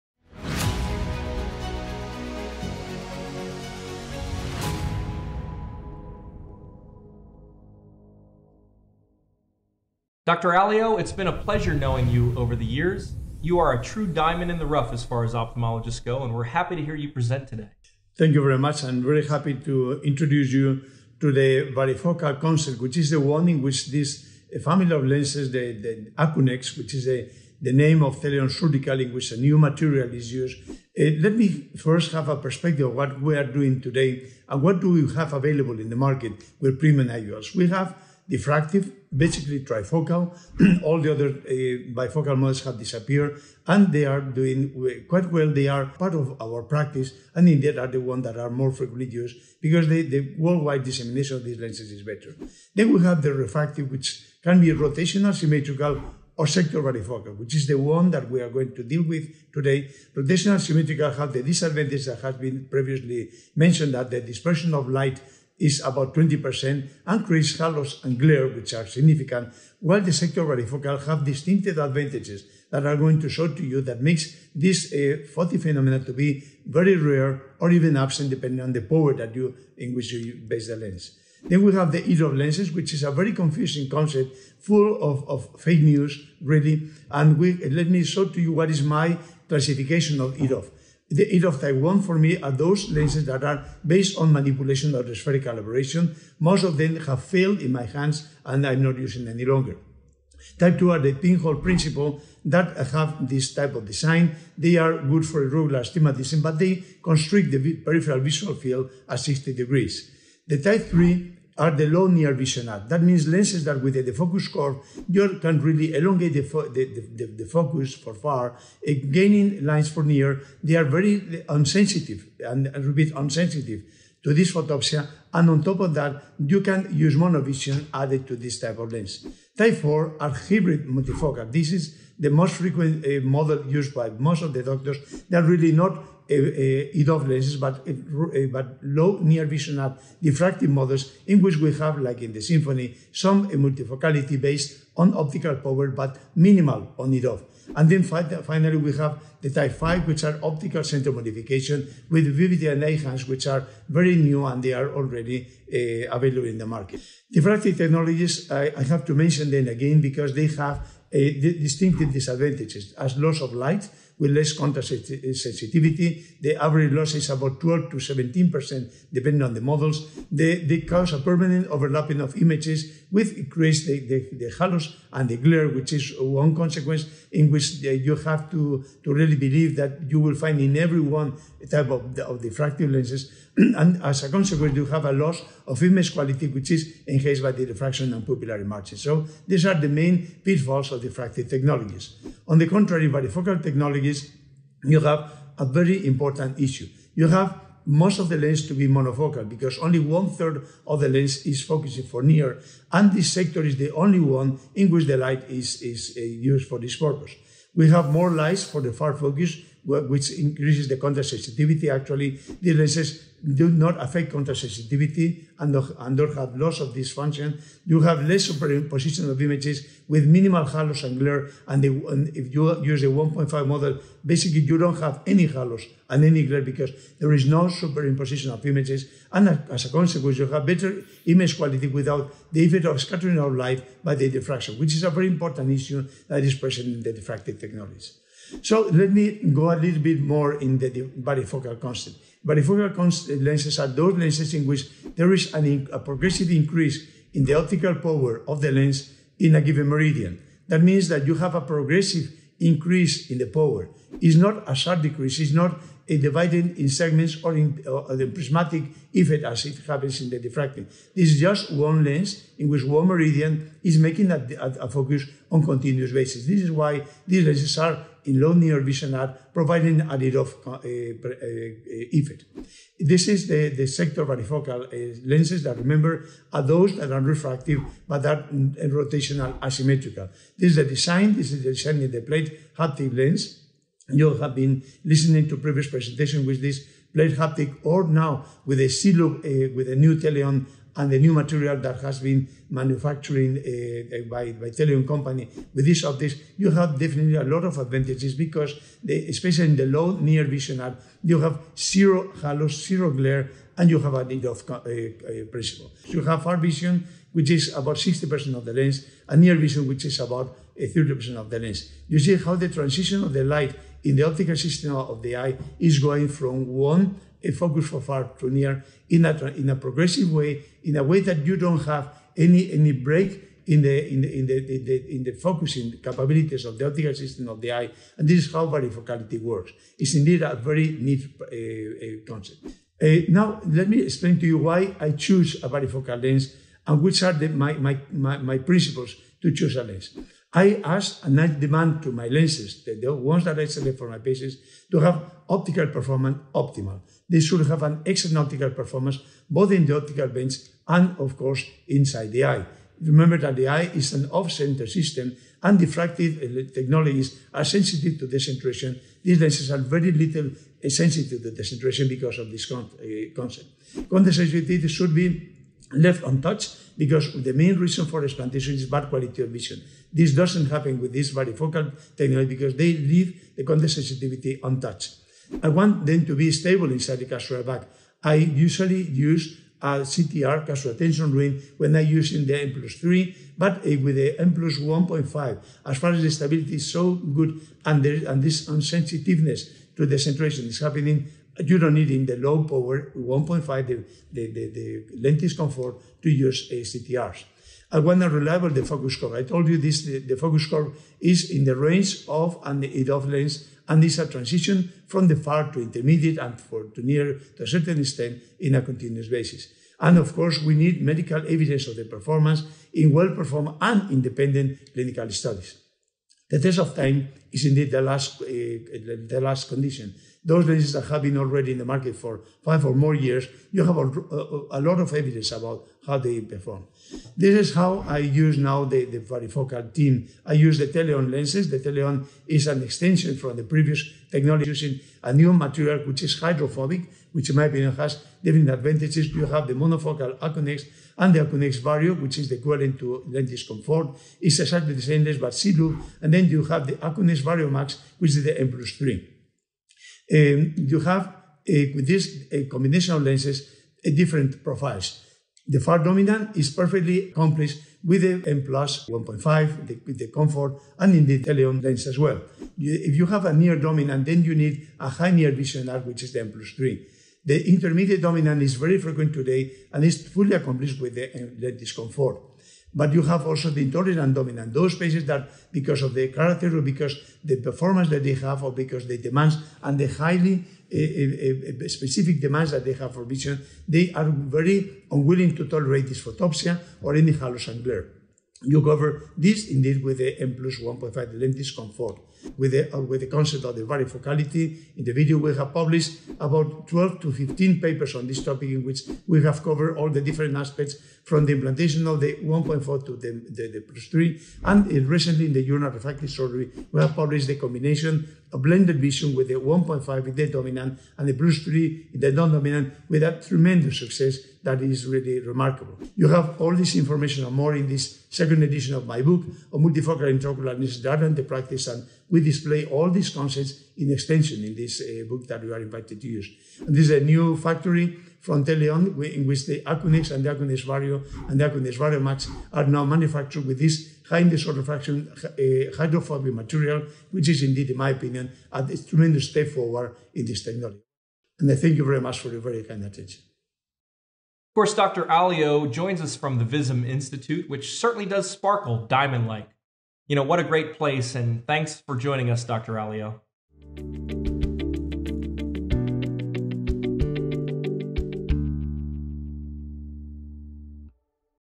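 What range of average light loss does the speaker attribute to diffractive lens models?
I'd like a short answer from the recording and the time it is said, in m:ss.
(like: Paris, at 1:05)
12 to 17%, at 2:47.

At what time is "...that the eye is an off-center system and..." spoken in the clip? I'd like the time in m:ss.
5:53.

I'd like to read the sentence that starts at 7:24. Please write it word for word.
It's exactly the same lens, but Silu.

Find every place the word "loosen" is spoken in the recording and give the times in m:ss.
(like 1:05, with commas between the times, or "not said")
not said.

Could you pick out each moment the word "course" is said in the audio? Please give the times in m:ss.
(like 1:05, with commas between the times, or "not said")
5:51, 6:50, 9:04.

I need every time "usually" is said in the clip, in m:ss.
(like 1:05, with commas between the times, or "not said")
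6:18.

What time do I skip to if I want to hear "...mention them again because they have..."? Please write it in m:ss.
2:39.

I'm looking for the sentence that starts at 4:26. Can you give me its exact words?
This is why these lenses are in low near vision are providing a little uh, uh, uh, effect.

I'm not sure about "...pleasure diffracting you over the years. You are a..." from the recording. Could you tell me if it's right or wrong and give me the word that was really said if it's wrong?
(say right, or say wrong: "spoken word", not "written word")
wrong: "knowing", not "diffracting".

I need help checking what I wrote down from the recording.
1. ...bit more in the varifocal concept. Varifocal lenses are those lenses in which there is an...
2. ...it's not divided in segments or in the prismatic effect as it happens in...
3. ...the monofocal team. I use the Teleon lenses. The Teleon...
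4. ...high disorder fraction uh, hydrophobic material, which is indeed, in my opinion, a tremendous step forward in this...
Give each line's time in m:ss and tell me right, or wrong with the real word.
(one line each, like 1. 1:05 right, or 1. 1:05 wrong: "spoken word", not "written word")
1. 4:00 right
2. 4:15 right
3. 7:09 wrong: "varifocal", not "monofocal"
4. 8:54 right.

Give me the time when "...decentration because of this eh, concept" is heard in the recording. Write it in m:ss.
6:01.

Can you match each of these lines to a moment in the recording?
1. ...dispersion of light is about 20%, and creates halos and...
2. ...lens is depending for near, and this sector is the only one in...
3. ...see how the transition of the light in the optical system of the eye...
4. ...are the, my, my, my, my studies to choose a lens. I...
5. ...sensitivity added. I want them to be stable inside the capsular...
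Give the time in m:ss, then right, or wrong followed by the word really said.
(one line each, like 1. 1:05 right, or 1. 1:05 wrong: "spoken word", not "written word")
1. 1:04 right
2. 3:21 wrong: "focusing", not "depending"
3. 5:12 right
4. 5:37 wrong: "principles", not "studies"
5. 6:13 wrong: "untouched", not "added".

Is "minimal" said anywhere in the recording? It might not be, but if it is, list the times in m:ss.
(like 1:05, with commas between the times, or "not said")
2:26, 3:40.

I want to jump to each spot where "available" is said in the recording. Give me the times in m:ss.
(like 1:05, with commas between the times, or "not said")
0:35, 2:36.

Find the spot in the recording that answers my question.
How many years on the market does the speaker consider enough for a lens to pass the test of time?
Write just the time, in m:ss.
7:02.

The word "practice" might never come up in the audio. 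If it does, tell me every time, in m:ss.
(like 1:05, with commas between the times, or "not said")
0:46, 8:41.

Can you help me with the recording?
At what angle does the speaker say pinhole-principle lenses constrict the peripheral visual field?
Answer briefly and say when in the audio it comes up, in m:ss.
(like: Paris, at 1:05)
60 degrees, at 1:49.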